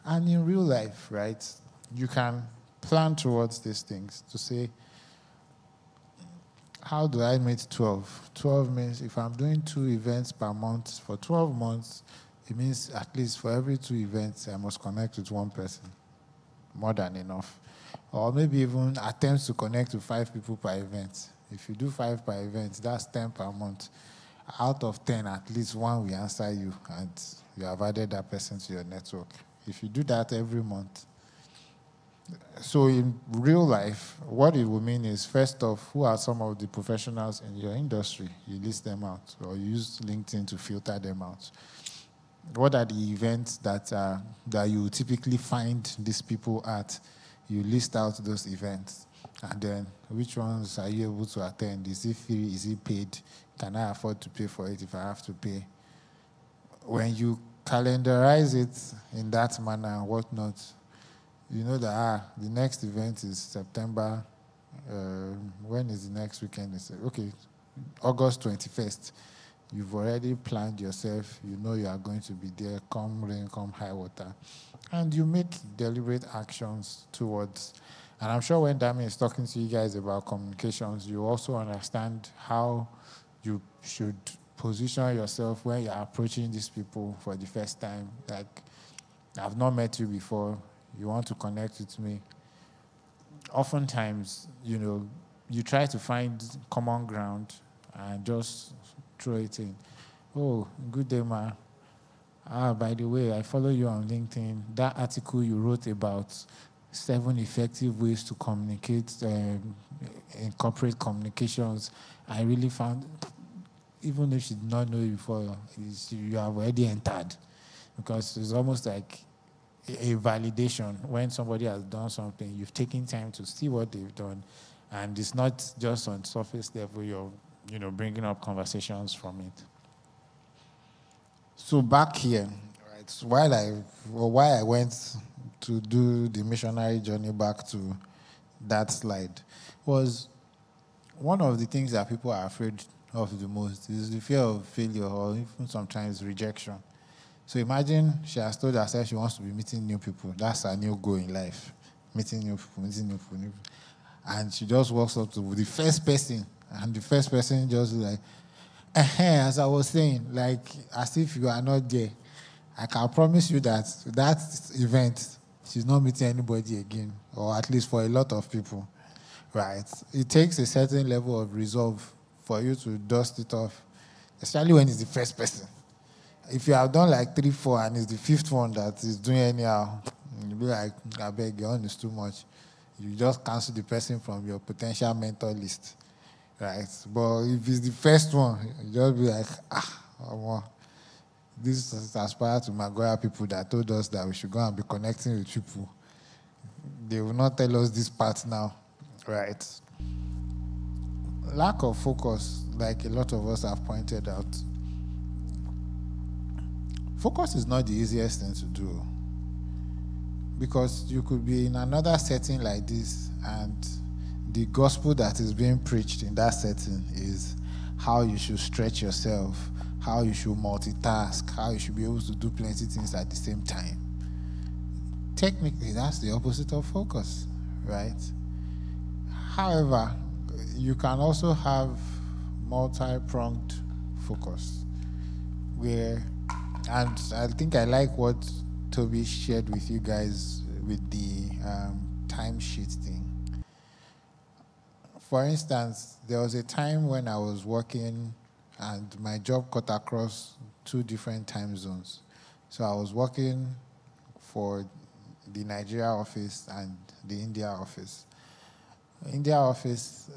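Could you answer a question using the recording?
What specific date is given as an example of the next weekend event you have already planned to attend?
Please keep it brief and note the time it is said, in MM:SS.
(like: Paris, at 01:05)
August 21st, at 01:08.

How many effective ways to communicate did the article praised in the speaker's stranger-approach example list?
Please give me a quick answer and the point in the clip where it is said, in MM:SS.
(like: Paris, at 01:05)
7, at 01:46.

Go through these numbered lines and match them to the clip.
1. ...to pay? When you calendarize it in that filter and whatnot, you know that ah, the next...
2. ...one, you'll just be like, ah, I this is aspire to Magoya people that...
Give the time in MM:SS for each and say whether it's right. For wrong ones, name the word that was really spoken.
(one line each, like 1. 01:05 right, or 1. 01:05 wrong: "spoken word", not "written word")
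1. 00:55 wrong: "manner", not "filter"
2. 03:08 right.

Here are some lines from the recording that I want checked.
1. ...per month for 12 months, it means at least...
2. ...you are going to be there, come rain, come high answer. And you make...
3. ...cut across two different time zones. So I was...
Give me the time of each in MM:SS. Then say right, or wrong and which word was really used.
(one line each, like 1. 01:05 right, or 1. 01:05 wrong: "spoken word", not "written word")
1. 00:10 right
2. 01:11 wrong: "water", not "answer"
3. 04:09 right.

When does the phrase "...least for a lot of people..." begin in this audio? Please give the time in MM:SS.
02:47.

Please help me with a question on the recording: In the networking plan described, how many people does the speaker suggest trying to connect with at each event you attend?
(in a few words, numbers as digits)
5.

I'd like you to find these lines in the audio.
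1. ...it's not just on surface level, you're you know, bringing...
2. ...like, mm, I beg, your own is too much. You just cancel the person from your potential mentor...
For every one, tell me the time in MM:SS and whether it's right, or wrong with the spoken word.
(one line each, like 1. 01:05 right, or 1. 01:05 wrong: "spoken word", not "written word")
1. 02:05 right
2. 03:00 right.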